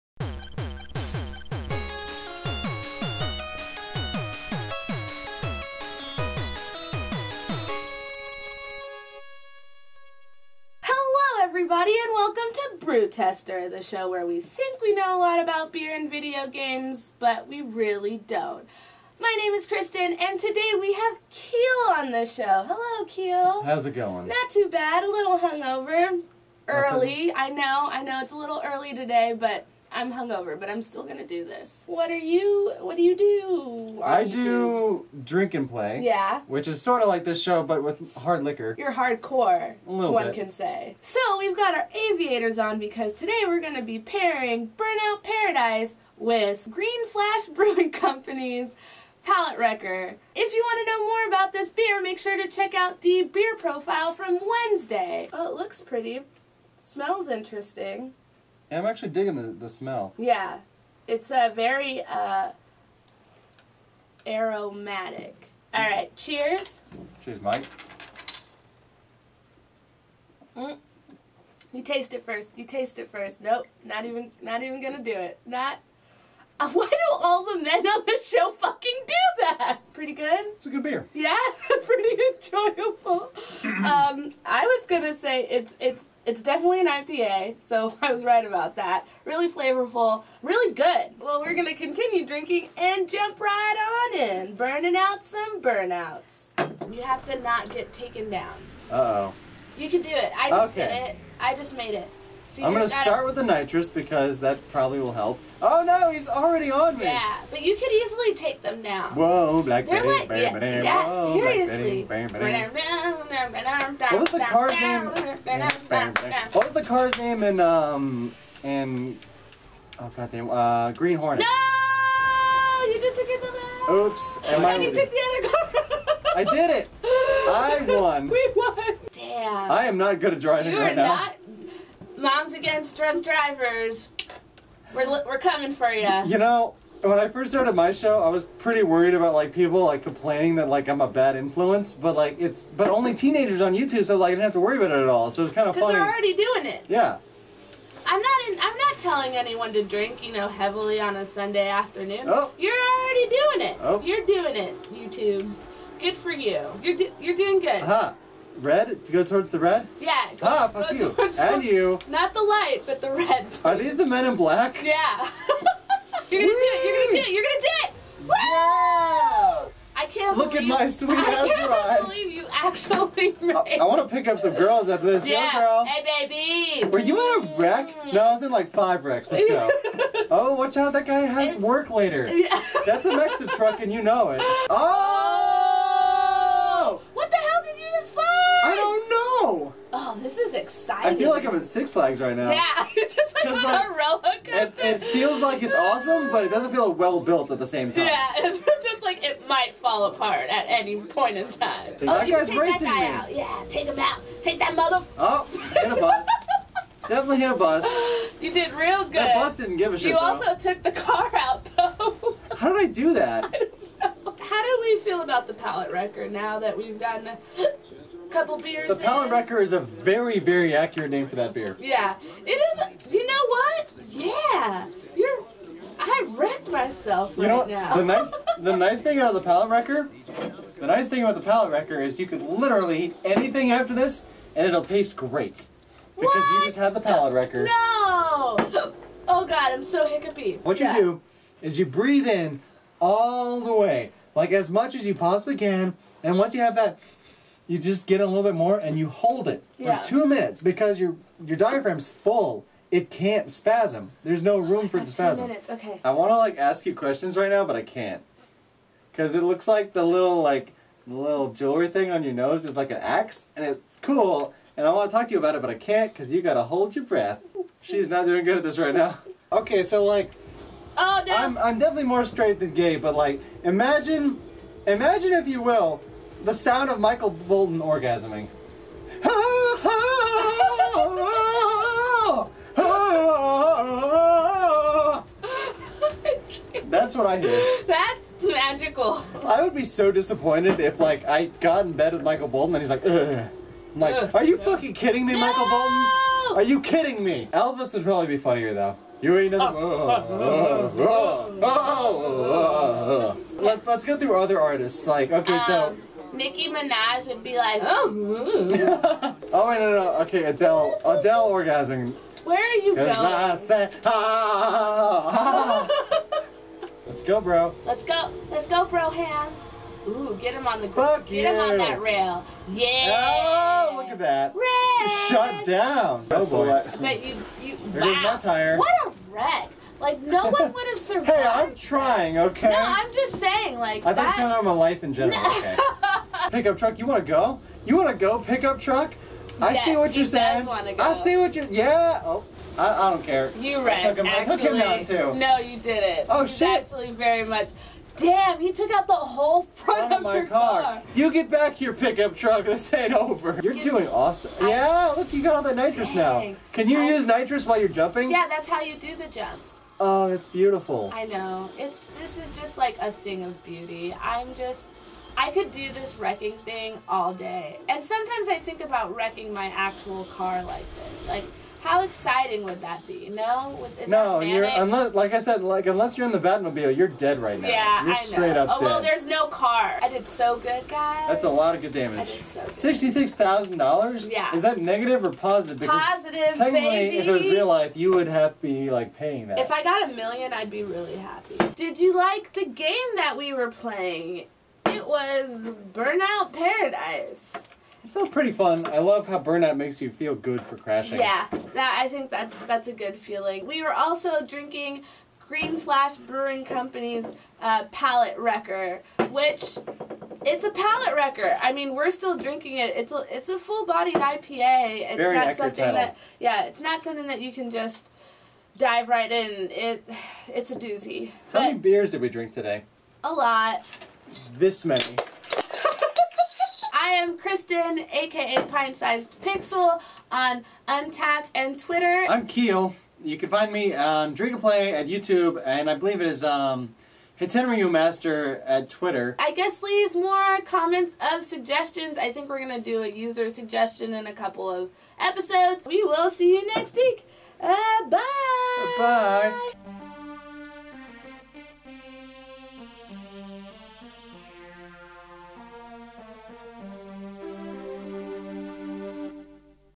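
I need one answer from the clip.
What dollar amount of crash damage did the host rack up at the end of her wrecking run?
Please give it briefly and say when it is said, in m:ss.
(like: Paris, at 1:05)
$66,000, at 6:22.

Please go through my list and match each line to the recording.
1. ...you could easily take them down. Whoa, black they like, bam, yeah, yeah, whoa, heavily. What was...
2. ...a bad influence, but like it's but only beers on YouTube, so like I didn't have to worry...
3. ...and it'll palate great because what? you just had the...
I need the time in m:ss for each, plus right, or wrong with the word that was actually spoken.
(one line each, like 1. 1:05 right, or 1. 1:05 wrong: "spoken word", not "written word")
1. 1:47 wrong: "seriously", not "heavily"
2. 2:21 wrong: "teenagers", not "beers"
3. 3:54 wrong: "taste", not "palate".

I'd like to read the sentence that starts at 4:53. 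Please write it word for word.
I'm like, are you fucking kidding me, no!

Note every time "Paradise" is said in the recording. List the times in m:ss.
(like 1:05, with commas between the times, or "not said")
0:45, 6:36.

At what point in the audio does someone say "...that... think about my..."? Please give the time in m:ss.
5:34.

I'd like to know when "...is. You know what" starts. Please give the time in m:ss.
3:42.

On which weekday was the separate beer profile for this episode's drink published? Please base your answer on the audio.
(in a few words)
Wednesday.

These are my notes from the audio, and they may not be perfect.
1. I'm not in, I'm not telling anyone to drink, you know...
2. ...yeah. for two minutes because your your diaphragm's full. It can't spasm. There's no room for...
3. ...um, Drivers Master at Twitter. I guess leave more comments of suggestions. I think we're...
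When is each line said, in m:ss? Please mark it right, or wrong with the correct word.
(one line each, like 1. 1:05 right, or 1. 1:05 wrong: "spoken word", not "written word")
1. 2:28 right
2. 4:09 right
3. 7:16 wrong: "Hitenryu", not "Drivers".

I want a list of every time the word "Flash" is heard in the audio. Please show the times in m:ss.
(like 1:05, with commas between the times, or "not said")
0:47, 6:45.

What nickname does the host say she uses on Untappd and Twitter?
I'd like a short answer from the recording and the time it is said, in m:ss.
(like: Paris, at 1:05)
Pint Sized Pixel, at 7:08.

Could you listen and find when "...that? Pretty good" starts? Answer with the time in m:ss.
1:19.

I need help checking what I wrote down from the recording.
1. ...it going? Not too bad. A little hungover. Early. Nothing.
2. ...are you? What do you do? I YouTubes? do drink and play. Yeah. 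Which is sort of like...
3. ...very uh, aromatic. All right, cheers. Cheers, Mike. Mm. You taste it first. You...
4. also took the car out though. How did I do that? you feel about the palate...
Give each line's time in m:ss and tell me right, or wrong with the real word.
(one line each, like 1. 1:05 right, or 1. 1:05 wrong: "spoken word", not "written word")
1. 0:23 right
2. 0:32 right
3. 1:01 right
4. 3:30 right.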